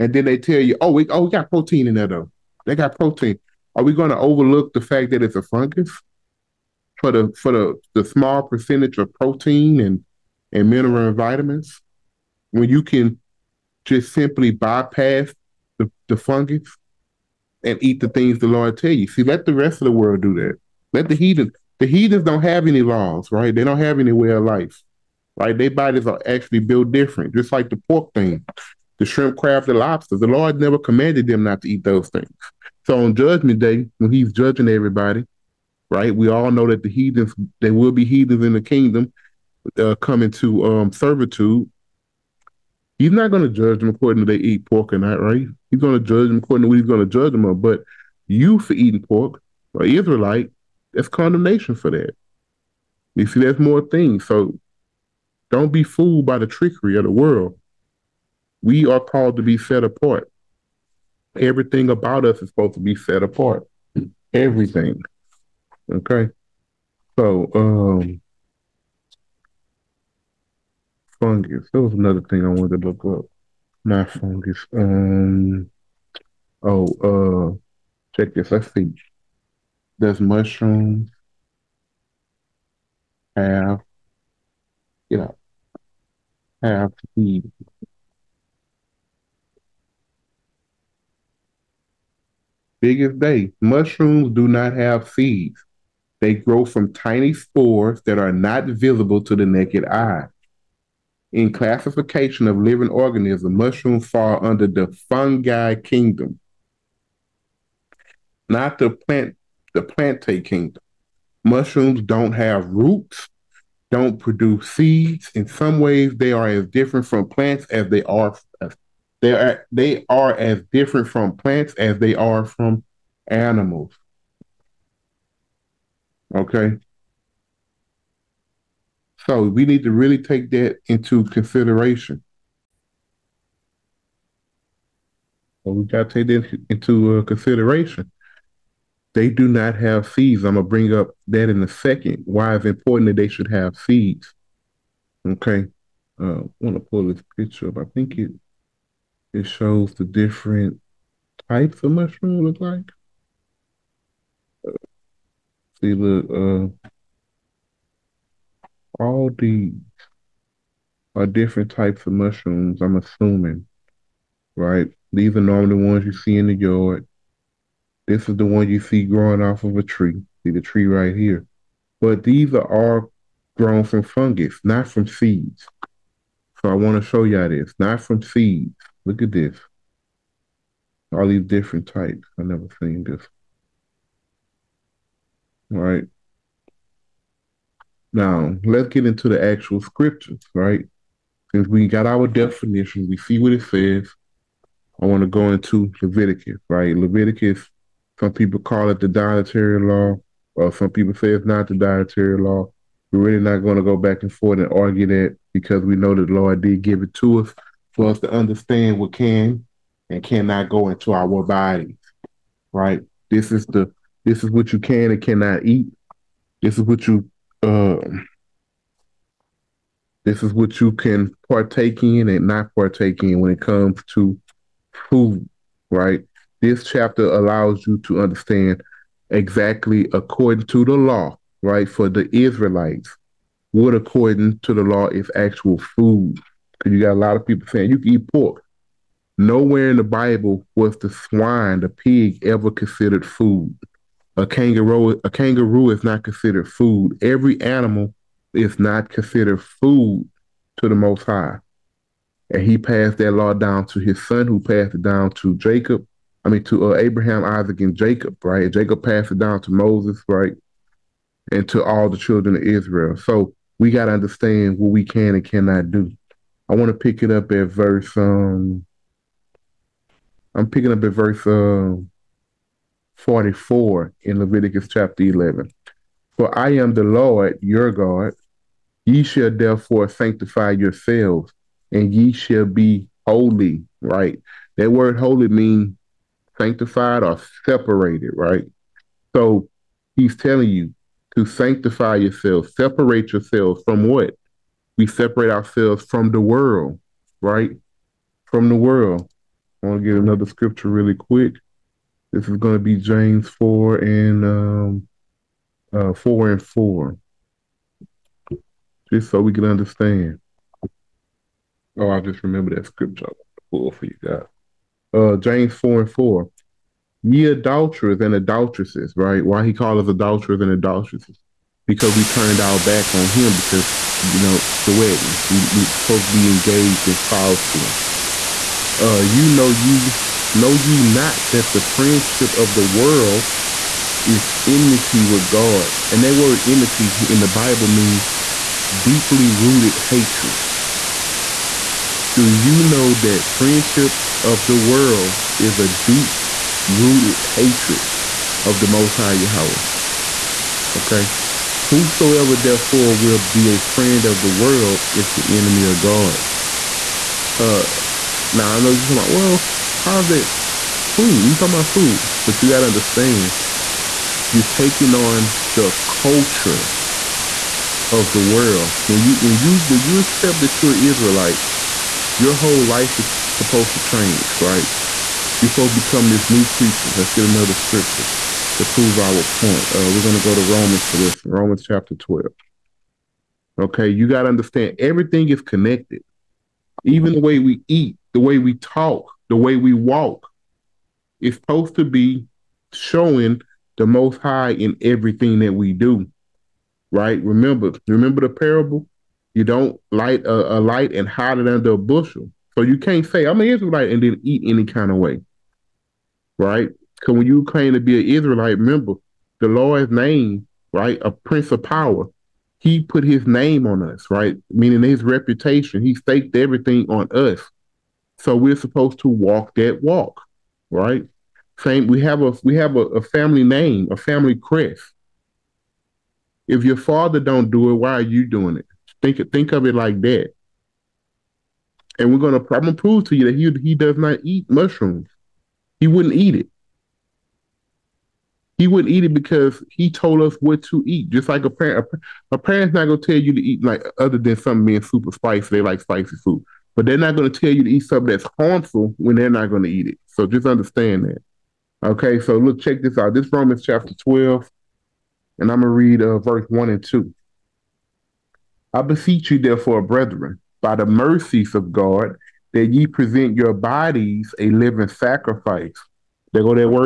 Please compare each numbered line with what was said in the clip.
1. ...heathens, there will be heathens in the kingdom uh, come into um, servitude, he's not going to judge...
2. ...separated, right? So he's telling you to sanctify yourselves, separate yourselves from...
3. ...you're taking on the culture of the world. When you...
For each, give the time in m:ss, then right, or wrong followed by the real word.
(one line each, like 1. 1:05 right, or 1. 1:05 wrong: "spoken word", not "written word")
1. 0:36 right
2. 4:47 right
3. 6:04 right.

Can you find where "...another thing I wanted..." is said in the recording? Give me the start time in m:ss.
1:11.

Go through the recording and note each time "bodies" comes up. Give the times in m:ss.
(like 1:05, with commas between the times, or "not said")
0:25, 3:31, 7:43.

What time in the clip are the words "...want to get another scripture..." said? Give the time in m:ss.
4:59.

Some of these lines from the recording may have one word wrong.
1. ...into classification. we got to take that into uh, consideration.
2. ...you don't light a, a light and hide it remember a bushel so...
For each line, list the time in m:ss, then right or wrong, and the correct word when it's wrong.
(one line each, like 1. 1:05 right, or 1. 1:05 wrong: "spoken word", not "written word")
1. 2:10 wrong: "consideration", not "classification"
2. 6:39 wrong: "under", not "remember".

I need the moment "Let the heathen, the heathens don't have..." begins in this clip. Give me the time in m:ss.
0:20.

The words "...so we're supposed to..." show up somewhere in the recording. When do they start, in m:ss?
6:58.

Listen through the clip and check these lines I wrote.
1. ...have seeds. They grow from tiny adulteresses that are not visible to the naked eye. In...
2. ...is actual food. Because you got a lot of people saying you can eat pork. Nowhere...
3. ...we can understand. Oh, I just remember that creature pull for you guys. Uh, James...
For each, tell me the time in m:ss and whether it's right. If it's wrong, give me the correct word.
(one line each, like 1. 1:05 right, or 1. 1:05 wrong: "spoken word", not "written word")
1. 1:34 wrong: "spores", not "adulteresses"
2. 3:55 right
3. 5:09 wrong: "scripture", not "creature".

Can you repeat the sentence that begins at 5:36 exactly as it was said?
And that word enmity in the Bible means deeply rooted hatred.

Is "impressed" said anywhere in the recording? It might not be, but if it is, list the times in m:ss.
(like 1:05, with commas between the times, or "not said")
not said.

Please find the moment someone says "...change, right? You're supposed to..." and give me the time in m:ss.
6:14.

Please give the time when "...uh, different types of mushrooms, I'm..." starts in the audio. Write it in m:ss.
2:41.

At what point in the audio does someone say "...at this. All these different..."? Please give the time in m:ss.
2:59.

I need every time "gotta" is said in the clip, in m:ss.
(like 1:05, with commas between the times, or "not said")
6:02.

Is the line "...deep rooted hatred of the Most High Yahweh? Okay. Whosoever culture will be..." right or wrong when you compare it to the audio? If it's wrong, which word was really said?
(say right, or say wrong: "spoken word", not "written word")
wrong: "therefore", not "culture".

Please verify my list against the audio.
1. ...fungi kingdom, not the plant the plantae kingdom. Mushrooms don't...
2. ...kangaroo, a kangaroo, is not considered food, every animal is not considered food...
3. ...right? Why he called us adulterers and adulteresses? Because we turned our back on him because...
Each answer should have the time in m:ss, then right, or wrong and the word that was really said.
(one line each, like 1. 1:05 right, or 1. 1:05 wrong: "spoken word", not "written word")
1. 1:45 right
2. 4:04 right
3. 5:19 right.